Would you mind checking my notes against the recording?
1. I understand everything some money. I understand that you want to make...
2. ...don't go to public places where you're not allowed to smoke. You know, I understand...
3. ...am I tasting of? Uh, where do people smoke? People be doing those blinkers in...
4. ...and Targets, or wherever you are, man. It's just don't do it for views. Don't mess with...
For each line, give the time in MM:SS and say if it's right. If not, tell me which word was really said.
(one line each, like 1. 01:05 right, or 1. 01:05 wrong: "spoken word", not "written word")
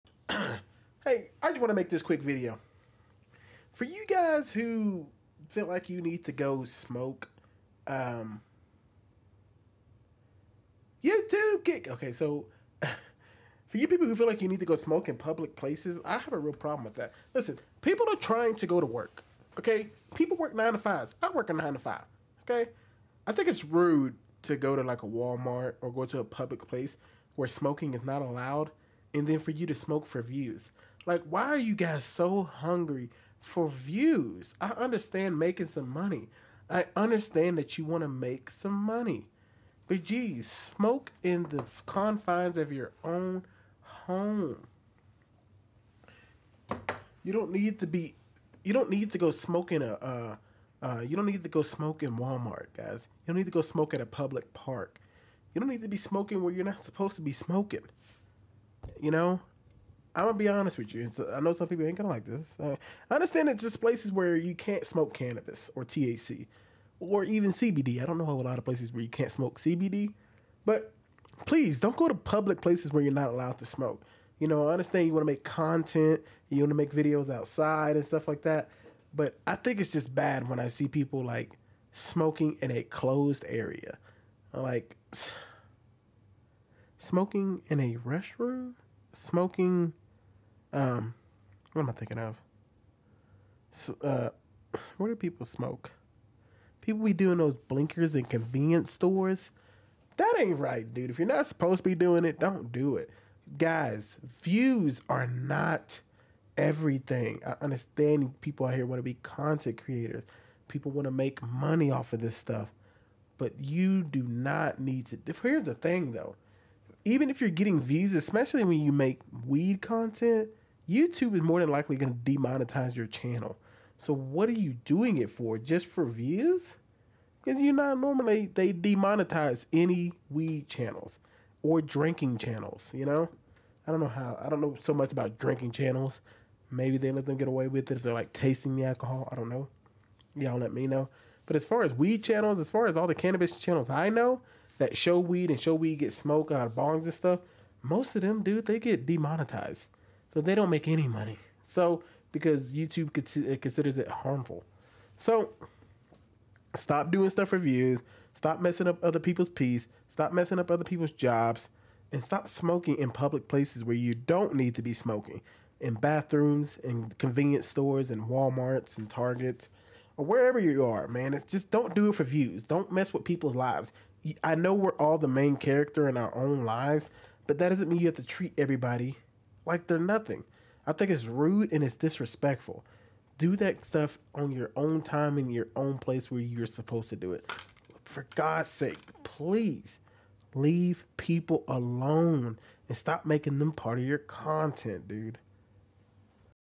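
1. 00:34 wrong: "making", not "everything"
2. 01:11 right
3. 01:31 wrong: "thinking", not "tasting"
4. 02:48 right.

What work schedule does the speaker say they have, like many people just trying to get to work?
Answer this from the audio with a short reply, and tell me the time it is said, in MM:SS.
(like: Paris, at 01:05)
nine to five, at 00:21.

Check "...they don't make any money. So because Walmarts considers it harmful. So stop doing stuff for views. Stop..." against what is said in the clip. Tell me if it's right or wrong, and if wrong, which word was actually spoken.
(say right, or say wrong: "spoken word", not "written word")
wrong: "YouTube", not "Walmarts".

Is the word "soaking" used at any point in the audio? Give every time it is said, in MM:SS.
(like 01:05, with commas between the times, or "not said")
not said.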